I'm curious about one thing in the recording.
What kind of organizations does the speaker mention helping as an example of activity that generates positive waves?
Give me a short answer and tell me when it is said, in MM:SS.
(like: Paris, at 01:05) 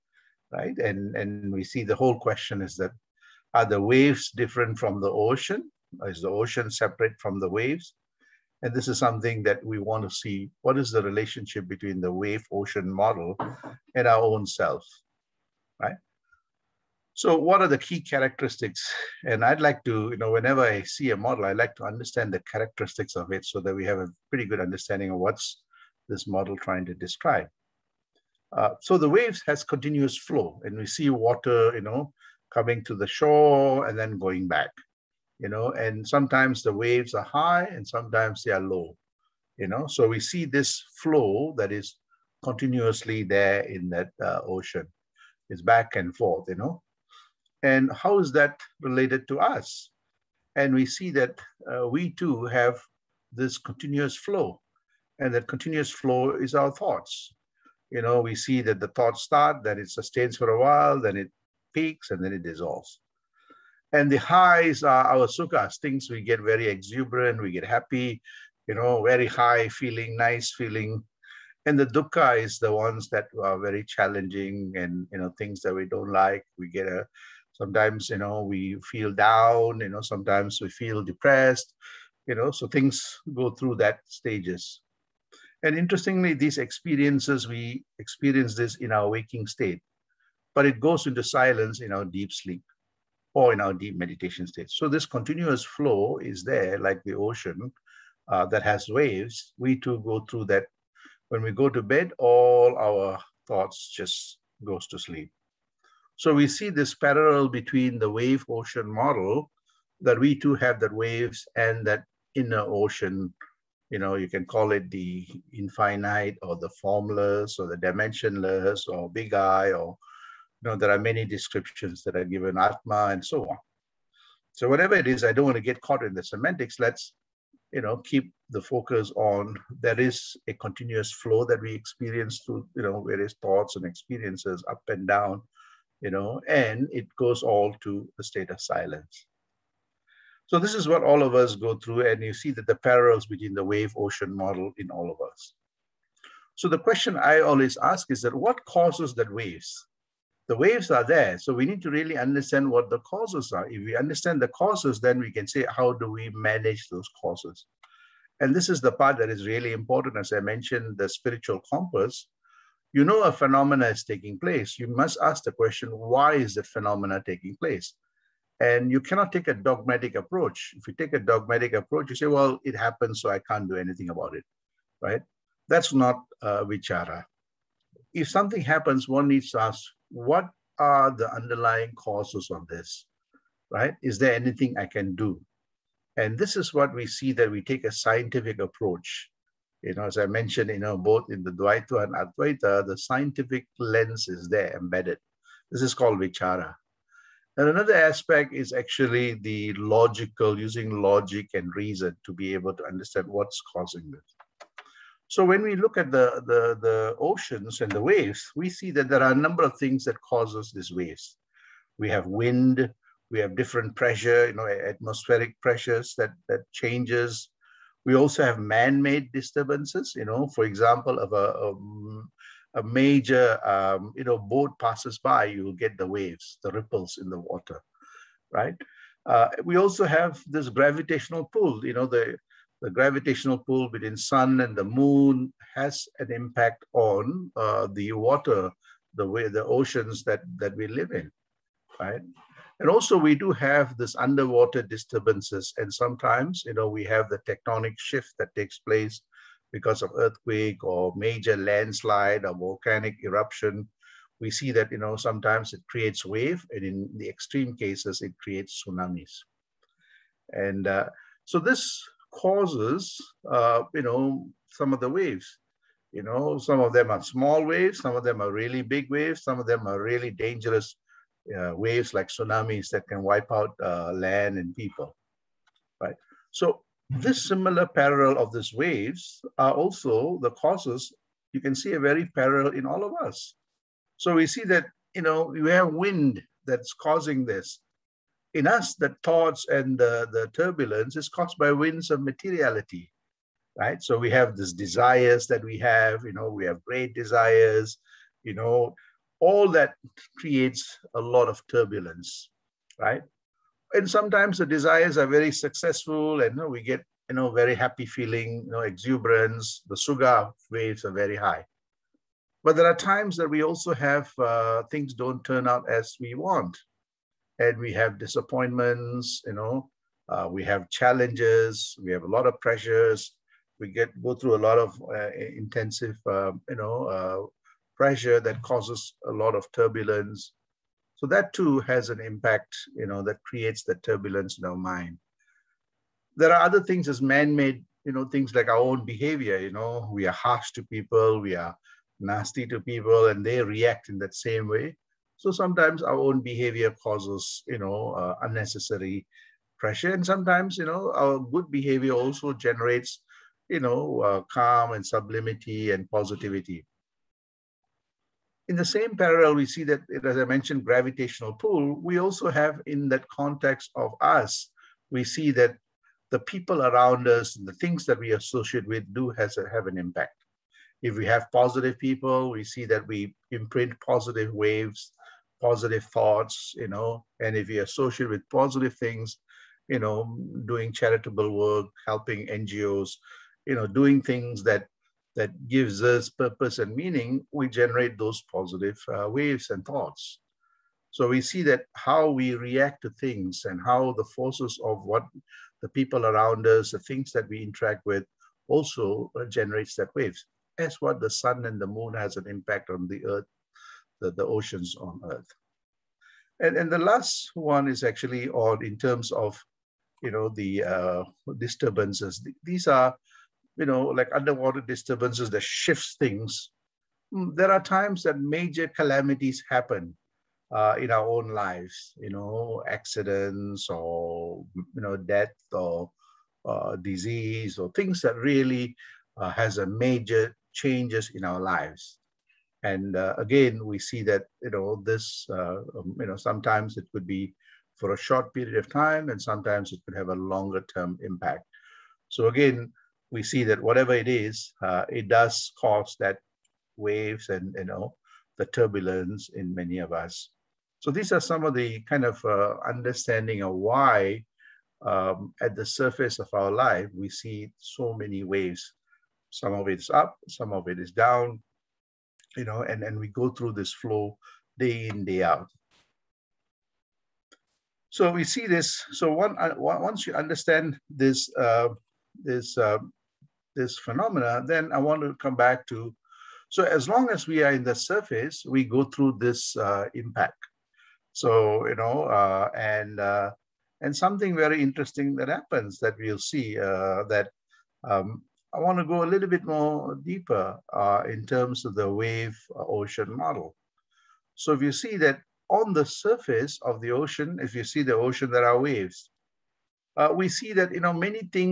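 NGOs, at 06:22.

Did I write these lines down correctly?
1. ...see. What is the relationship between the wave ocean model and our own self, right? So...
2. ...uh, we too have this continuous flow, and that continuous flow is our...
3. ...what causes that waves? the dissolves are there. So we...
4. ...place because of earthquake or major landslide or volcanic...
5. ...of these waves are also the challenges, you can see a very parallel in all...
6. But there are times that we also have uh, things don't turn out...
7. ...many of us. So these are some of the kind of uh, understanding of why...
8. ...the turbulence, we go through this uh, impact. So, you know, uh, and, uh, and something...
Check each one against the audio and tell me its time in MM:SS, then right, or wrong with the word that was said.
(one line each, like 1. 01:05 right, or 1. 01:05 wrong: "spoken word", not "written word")
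1. 00:10 right
2. 00:51 right
3. 02:28 wrong: "waves", not "dissolves"
4. 04:08 right
5. 04:38 wrong: "causes", not "challenges"
6. 05:12 right
7. 07:29 right
8. 07:57 wrong: "surface", not "turbulence".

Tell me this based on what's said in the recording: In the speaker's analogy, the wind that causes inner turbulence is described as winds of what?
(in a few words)
materiality.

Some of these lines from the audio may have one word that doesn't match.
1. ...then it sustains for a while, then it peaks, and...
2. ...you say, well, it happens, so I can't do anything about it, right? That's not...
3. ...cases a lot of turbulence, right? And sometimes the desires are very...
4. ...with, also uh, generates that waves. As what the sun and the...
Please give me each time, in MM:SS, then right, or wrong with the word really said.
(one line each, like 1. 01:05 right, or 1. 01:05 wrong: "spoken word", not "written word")
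1. 00:59 right
2. 02:52 right
3. 05:00 wrong: "creates", not "cases"
4. 06:38 right.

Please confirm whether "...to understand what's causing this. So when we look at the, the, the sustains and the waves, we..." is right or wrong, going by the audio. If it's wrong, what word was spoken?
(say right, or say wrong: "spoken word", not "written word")
wrong: "oceans", not "sustains".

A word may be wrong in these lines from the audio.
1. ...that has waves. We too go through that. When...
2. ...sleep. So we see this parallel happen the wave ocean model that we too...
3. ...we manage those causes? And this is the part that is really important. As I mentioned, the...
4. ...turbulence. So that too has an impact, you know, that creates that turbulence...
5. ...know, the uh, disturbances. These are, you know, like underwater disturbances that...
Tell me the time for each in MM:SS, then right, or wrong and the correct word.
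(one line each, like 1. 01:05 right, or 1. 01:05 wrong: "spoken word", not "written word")
1. 01:38 right
2. 01:44 wrong: "between", not "happen"
3. 02:36 right
4. 05:29 right
5. 06:50 right.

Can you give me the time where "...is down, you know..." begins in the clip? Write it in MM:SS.
07:40.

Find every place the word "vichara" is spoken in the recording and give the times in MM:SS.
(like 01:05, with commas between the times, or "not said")
02:56, 03:16.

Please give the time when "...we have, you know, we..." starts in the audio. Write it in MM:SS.
04:55.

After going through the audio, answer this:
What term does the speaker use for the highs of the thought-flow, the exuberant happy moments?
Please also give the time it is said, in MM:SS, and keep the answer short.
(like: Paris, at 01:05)
sukhas, at 01:05.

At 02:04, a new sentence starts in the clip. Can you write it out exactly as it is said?
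So whatever it is, I don't want to get caught in the semantics.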